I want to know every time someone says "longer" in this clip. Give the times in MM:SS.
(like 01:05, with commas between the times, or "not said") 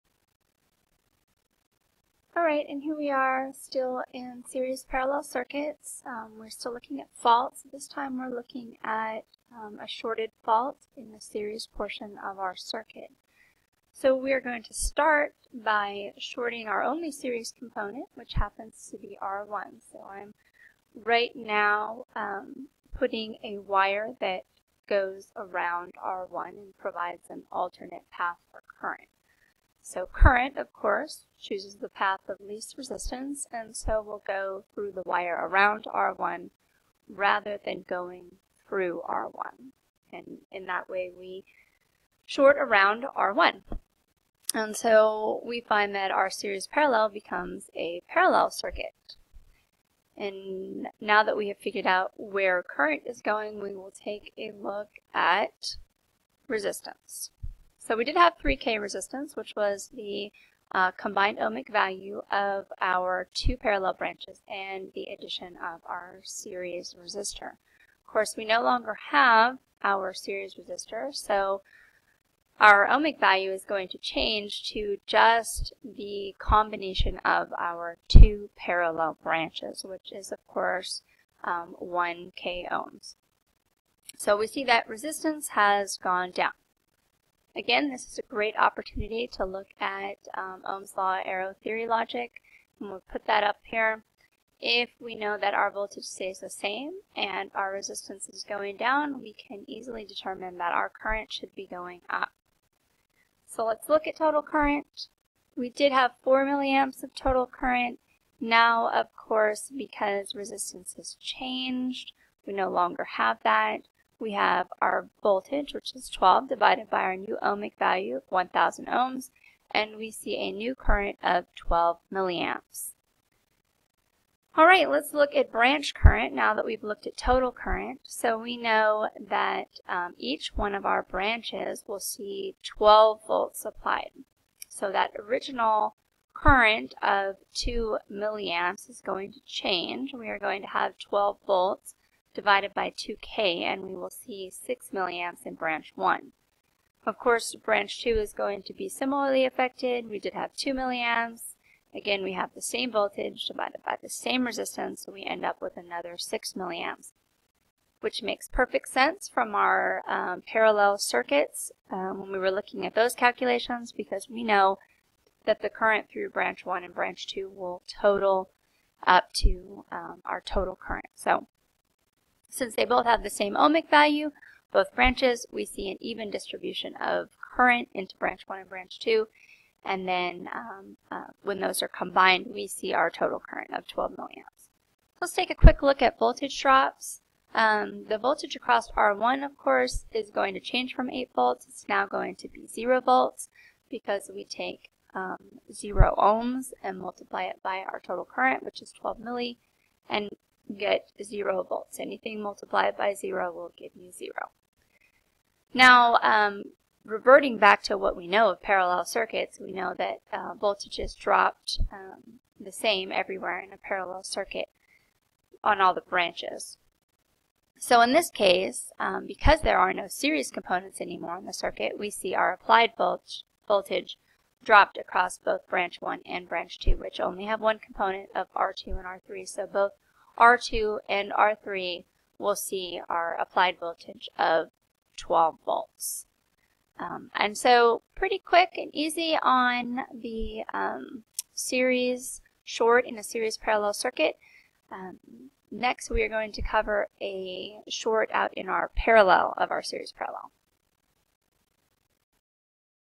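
01:08, 01:52.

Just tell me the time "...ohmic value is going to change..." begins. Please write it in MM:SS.
01:12.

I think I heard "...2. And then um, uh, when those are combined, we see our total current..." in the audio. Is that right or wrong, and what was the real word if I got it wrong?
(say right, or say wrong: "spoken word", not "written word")
right.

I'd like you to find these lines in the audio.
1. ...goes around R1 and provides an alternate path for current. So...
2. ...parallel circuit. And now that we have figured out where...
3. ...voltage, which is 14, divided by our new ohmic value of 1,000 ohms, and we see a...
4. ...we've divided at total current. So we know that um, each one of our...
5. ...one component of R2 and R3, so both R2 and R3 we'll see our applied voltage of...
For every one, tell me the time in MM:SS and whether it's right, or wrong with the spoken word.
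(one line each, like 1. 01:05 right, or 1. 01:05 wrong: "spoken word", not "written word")
1. 00:24 right
2. 00:48 right
3. 01:55 wrong: "12", not "14"
4. 02:06 wrong: "looked", not "divided"
5. 03:47 right.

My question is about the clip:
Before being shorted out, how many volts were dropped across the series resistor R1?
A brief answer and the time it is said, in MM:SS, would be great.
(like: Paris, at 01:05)
8 volts, at 03:11.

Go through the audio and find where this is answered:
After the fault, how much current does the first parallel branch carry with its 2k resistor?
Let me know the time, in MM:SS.
02:24.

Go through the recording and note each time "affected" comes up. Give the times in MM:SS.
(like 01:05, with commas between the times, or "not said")
02:29.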